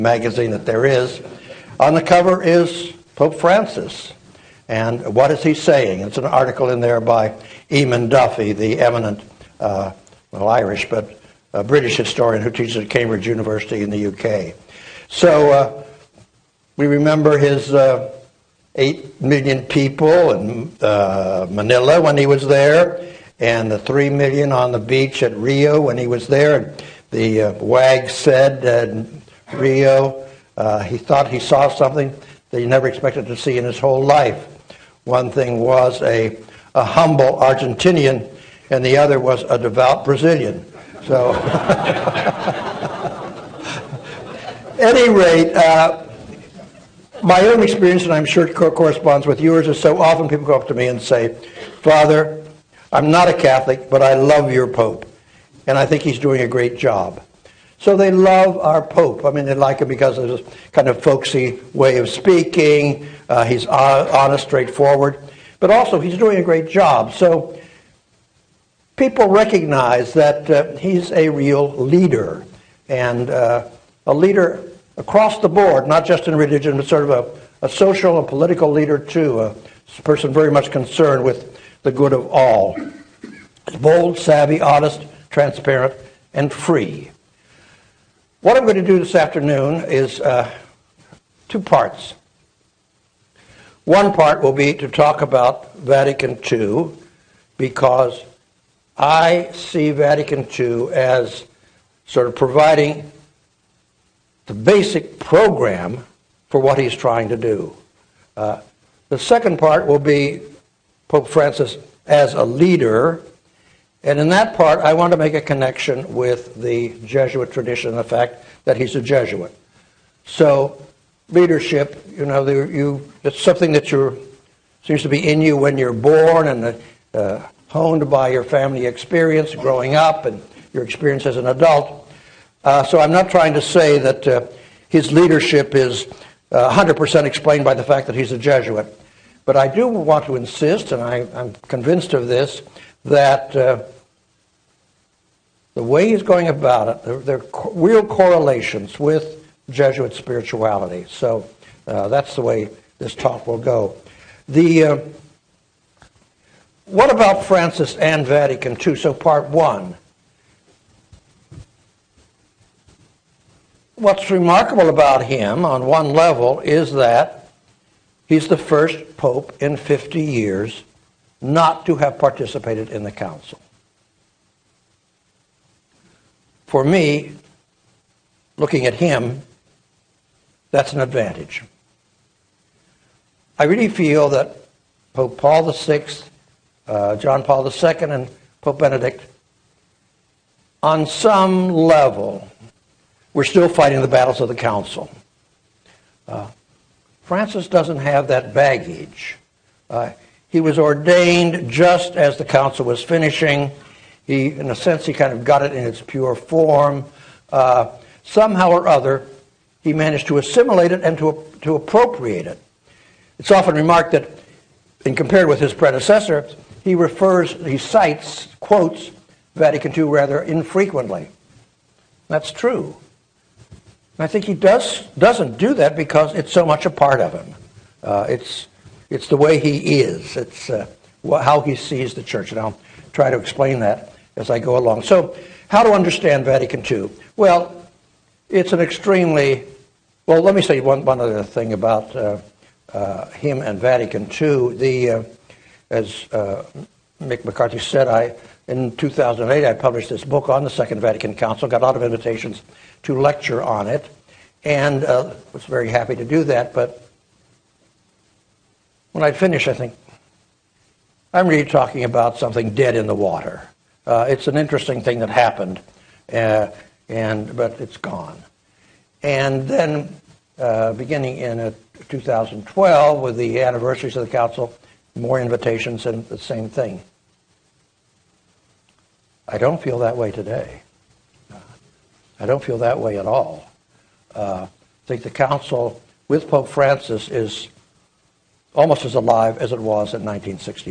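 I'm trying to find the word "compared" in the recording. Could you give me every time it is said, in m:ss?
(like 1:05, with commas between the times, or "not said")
3:35.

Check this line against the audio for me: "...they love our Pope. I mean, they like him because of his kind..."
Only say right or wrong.
right.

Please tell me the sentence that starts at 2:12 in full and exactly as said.
Uh, so, I'm not trying to say that uh, his leadership is 100% uh, explained by the fact that he's a Jesuit.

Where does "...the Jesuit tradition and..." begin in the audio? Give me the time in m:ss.
1:56.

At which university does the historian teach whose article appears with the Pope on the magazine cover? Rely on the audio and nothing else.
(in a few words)
Cambridge University.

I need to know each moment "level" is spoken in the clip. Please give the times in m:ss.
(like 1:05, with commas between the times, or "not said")
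2:46, 3:11.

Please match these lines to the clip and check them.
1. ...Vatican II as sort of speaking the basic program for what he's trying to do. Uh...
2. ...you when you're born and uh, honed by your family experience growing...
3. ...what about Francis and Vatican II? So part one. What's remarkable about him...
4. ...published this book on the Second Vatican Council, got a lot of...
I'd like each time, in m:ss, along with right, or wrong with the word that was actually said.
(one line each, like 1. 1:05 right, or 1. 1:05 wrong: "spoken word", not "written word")
1. 1:39 wrong: "providing", not "speaking"
2. 2:05 right
3. 2:36 right
4. 4:09 right.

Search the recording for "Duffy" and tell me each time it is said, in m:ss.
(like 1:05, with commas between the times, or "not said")
0:08.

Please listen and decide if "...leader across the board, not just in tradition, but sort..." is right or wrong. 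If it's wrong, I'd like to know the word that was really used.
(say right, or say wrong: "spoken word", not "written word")
wrong: "religion", not "tradition".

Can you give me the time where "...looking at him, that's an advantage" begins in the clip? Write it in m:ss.
2:58.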